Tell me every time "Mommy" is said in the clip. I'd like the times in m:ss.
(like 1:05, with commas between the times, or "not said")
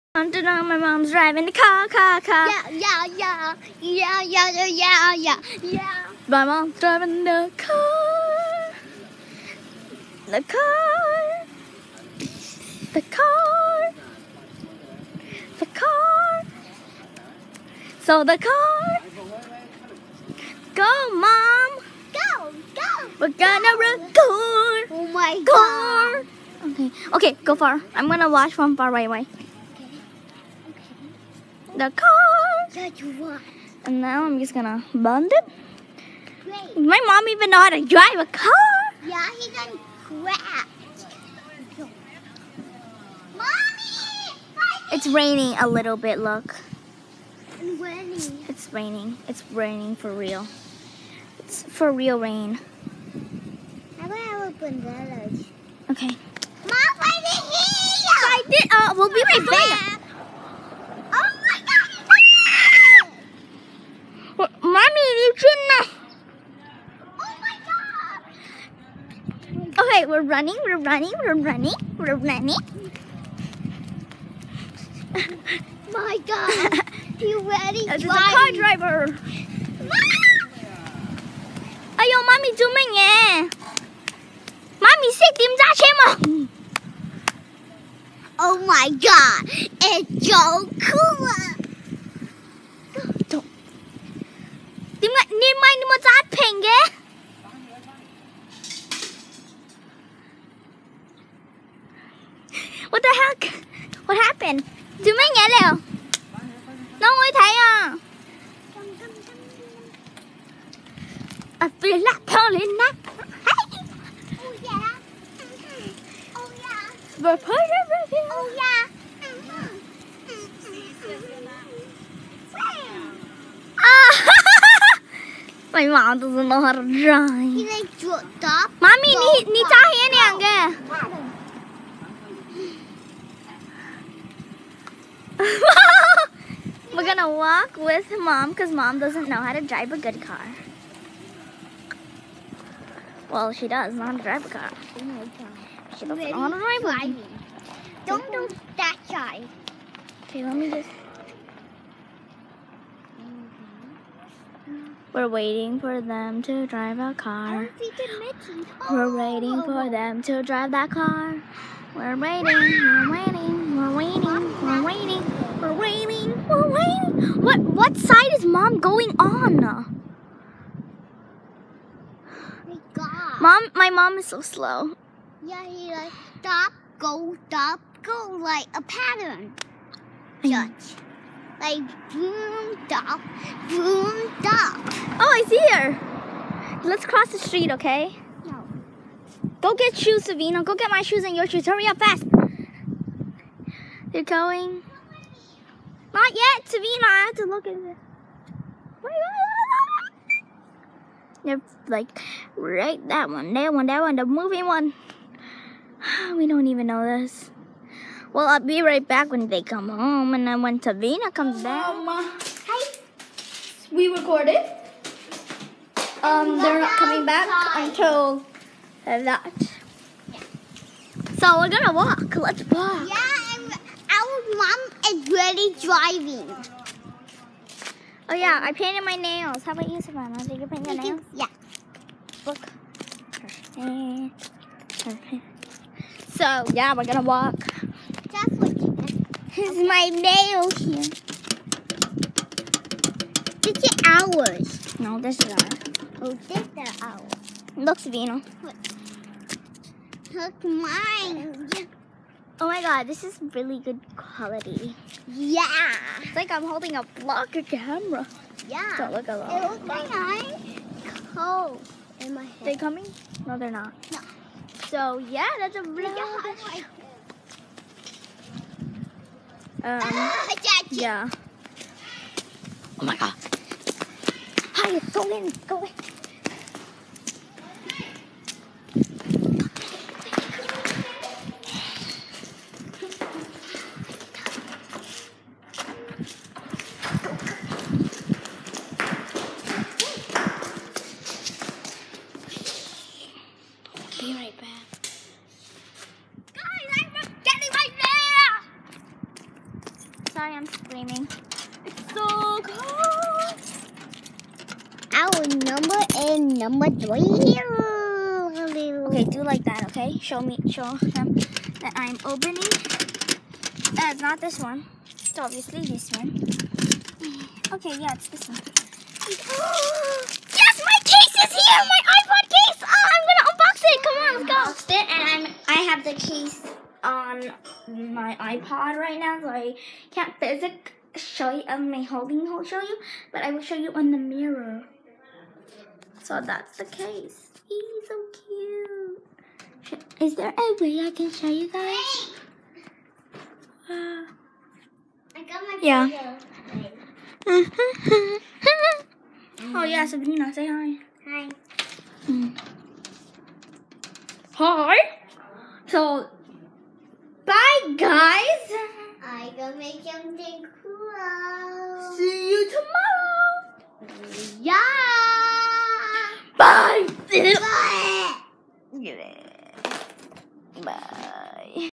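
0:43, 2:08.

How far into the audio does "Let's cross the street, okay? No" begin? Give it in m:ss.
3:06.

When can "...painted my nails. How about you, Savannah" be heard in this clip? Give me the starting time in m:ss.
3:48.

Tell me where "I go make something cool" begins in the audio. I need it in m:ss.
5:59.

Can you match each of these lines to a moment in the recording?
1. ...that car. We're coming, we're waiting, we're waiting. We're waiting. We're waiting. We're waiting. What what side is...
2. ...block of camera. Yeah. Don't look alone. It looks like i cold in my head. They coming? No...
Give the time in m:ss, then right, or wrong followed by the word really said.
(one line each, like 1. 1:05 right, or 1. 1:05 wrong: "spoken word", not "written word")
1. 2:40 wrong: "waiting", not "coming"
2. 4:17 right.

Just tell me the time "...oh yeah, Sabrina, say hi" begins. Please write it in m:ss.
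5:47.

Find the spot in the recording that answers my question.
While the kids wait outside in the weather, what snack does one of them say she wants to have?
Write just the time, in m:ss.
0:54.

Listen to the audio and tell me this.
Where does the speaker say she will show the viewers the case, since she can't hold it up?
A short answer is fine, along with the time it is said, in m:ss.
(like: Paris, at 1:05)
On the mirror, at 5:33.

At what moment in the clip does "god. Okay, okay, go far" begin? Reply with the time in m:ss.
0:26.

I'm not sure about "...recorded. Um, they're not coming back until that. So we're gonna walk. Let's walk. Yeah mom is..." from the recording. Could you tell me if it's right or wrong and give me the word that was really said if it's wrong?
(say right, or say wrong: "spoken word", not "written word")
right.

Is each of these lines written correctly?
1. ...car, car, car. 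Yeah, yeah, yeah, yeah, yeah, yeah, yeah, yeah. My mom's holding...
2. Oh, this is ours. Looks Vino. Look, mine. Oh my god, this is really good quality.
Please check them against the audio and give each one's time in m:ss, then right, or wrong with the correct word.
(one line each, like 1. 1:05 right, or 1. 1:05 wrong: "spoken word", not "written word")
1. 0:01 wrong: "driving", not "holding"
2. 4:06 right.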